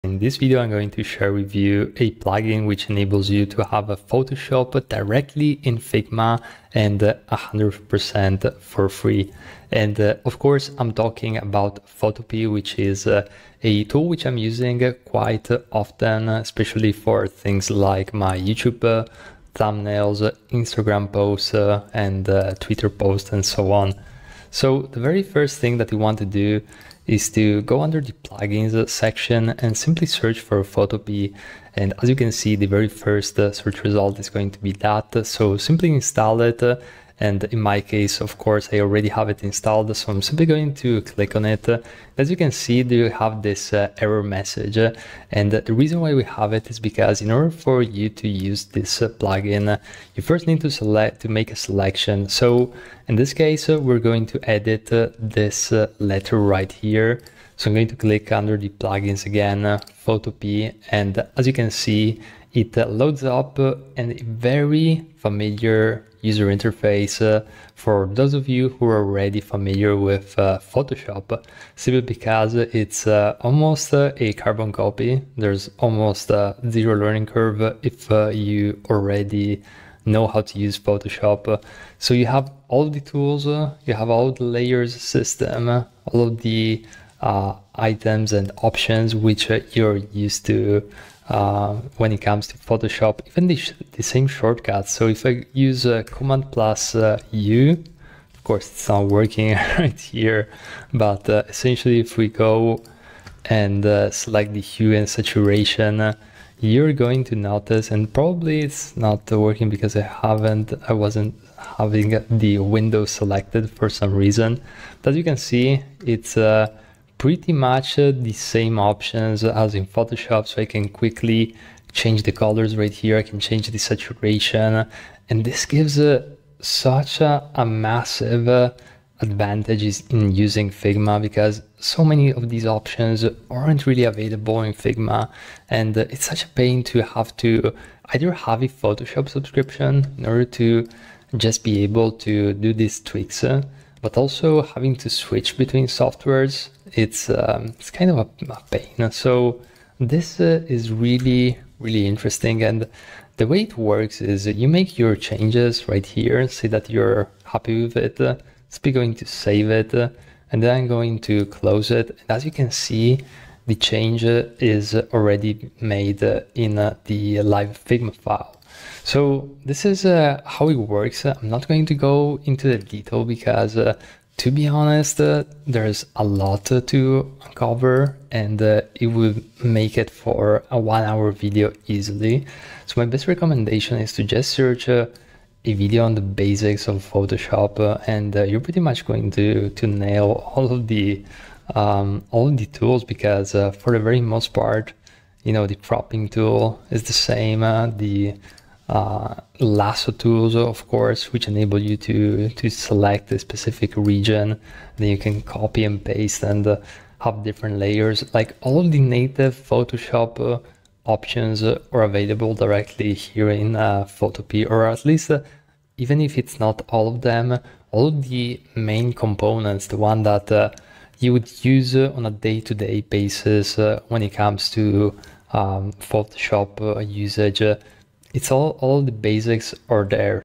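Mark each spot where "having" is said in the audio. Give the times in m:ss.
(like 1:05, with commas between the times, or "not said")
1:51, 2:24.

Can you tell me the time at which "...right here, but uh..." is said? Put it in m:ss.
1:39.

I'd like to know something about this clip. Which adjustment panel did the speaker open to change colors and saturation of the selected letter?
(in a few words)
Hue and saturation.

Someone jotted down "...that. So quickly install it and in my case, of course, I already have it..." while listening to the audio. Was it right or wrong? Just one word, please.
wrong.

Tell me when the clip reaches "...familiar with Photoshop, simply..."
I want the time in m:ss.
1:09.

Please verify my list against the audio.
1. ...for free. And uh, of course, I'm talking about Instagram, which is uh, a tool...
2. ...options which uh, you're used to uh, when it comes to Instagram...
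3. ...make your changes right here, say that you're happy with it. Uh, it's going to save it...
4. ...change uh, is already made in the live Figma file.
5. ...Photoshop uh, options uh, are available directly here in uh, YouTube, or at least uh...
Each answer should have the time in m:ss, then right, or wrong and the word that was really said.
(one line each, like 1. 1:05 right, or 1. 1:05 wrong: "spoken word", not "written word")
1. 0:08 wrong: "Photopea", not "Instagram"
2. 1:28 wrong: "Photoshop", not "Instagram"
3. 2:34 right
4. 2:43 right
5. 3:29 wrong: "Photopea", not "YouTube".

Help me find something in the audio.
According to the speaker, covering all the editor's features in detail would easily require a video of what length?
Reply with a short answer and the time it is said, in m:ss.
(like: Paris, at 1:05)
1 hour, at 3:00.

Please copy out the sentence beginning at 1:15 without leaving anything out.
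There's almost zero learning curve if you already know how to use Photoshop.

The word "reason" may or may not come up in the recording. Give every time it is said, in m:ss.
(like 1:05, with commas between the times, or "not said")
0:45, 1:54.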